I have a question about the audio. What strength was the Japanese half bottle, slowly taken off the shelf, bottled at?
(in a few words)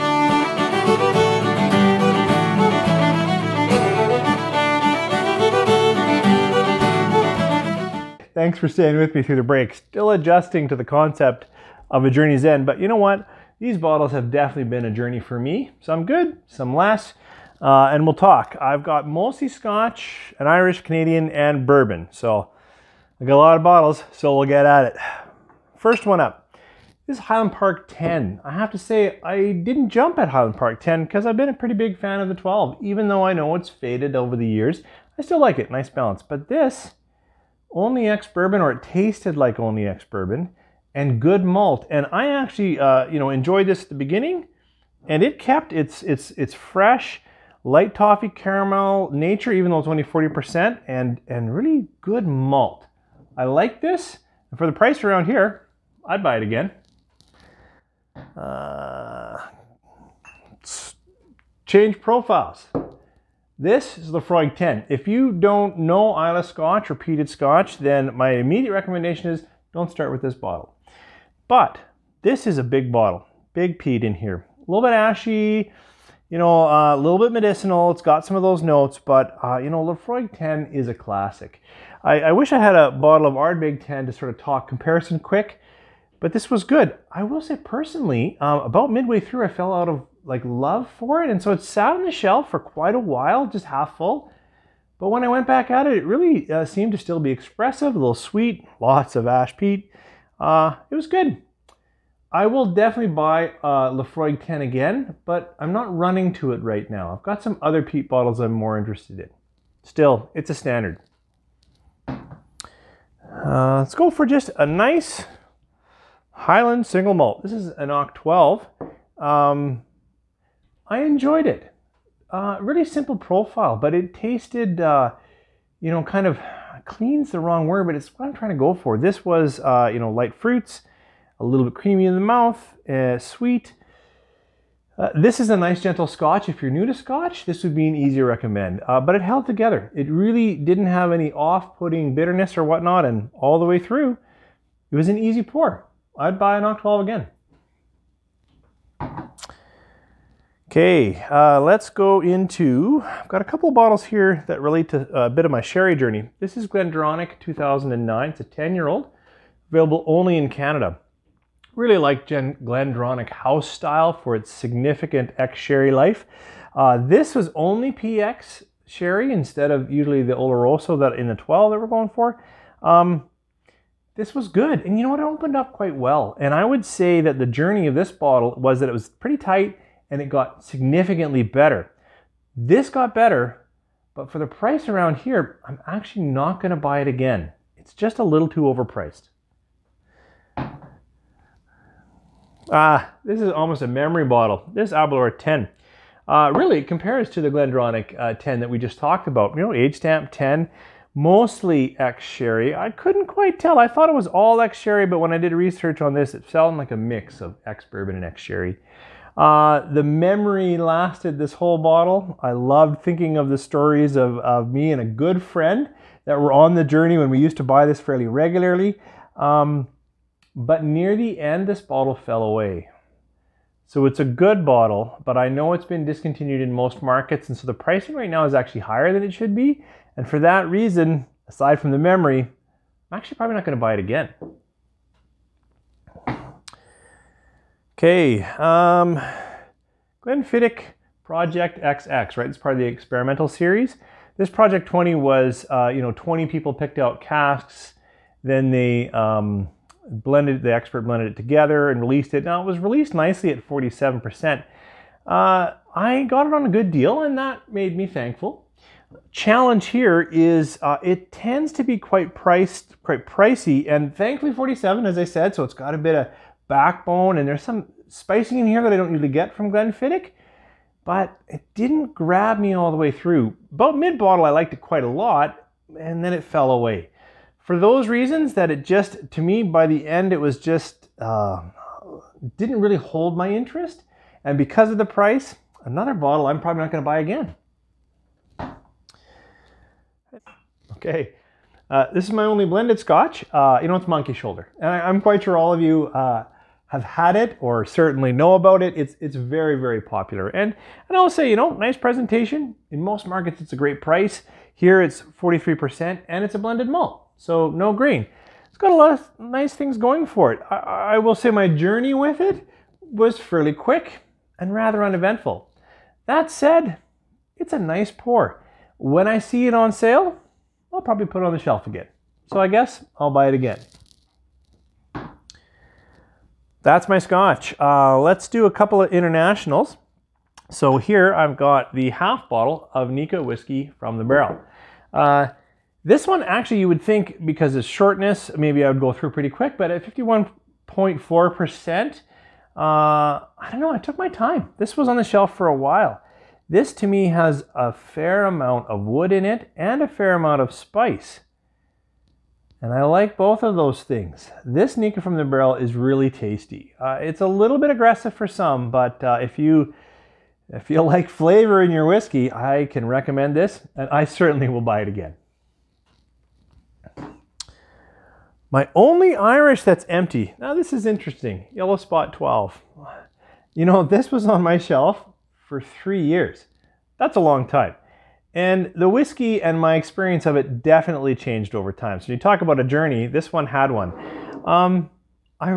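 51.4%.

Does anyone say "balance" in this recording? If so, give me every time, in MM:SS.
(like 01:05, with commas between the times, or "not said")
00:35.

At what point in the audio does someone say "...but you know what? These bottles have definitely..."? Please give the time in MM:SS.
00:12.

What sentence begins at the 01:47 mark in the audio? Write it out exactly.
I've got some other peat bottles I'm more interested in.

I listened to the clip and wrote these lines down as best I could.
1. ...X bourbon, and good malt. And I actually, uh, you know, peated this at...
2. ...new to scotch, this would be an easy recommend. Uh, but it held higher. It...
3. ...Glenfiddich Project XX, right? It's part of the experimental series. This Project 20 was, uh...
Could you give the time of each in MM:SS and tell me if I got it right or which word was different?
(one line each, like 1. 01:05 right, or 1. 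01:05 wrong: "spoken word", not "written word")
1. 00:39 wrong: "enjoyed", not "peated"
2. 02:16 wrong: "together", not "higher"
3. 04:00 right.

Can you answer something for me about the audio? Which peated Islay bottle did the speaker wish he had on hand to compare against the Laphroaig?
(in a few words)
Ardbeg 10.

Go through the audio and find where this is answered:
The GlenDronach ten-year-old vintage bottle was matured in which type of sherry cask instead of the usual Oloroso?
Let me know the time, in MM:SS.
02:47.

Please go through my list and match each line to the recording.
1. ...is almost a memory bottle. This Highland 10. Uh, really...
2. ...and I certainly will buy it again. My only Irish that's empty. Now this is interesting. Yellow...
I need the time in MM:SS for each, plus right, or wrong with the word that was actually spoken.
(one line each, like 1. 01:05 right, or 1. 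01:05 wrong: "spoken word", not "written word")
1. 03:13 wrong: "Aberlour", not "Highland"
2. 06:03 right.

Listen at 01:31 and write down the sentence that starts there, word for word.
And so it sat on the shelf for quite a while, just half full.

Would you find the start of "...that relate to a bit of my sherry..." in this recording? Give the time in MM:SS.
02:34.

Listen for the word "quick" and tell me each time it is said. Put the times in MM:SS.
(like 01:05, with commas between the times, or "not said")
01:25, 05:13, 05:39.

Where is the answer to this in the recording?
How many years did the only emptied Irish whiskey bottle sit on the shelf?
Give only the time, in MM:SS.
06:15.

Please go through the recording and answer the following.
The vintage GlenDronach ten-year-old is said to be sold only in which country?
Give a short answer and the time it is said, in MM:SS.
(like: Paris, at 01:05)
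Canada, at 02:40.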